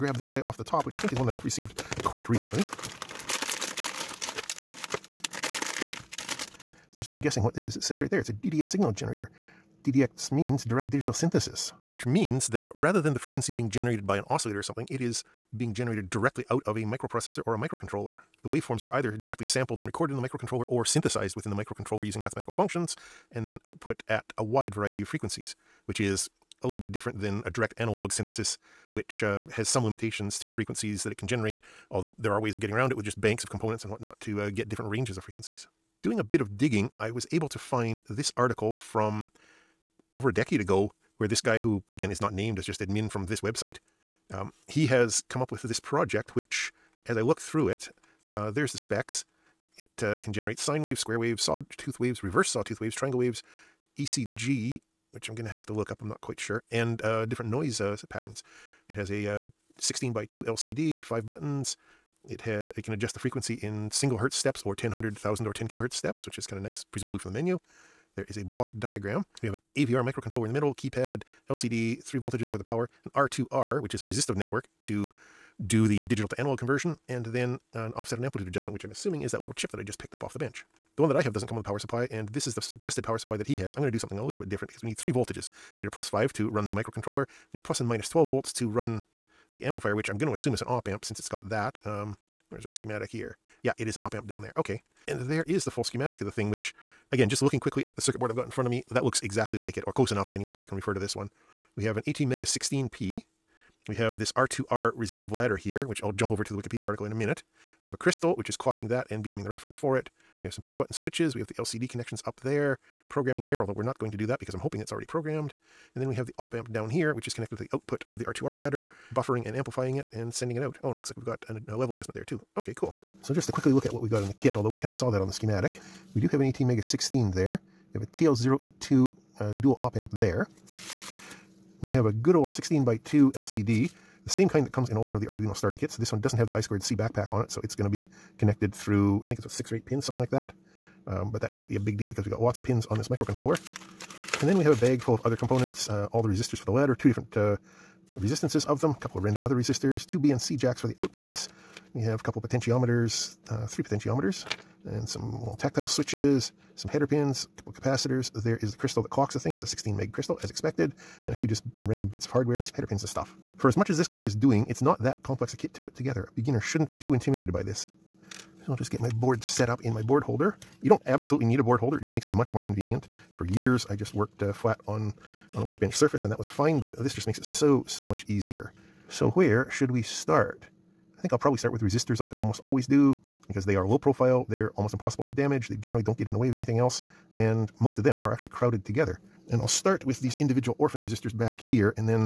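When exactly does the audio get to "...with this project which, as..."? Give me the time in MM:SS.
00:45.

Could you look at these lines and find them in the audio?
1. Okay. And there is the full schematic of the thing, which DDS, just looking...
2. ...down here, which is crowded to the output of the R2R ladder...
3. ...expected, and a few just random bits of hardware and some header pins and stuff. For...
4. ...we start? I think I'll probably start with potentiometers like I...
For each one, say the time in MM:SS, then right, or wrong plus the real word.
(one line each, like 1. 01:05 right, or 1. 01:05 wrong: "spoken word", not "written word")
1. 01:34 wrong: "Again", not "DDS"
2. 01:56 wrong: "connected", not "crowded"
3. 02:40 right
4. 02:59 wrong: "resistors", not "potentiometers".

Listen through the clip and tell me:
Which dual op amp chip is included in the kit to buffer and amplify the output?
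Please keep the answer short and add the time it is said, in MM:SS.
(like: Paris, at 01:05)
TL082, at 02:08.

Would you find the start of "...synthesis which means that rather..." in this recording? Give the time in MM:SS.
00:11.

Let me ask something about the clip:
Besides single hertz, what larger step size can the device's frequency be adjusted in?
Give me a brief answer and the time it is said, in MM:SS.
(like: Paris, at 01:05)
10 kilohertz, at 01:05.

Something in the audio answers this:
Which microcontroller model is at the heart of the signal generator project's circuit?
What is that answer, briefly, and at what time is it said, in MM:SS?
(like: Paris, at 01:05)
ATmega 16P, at 01:42.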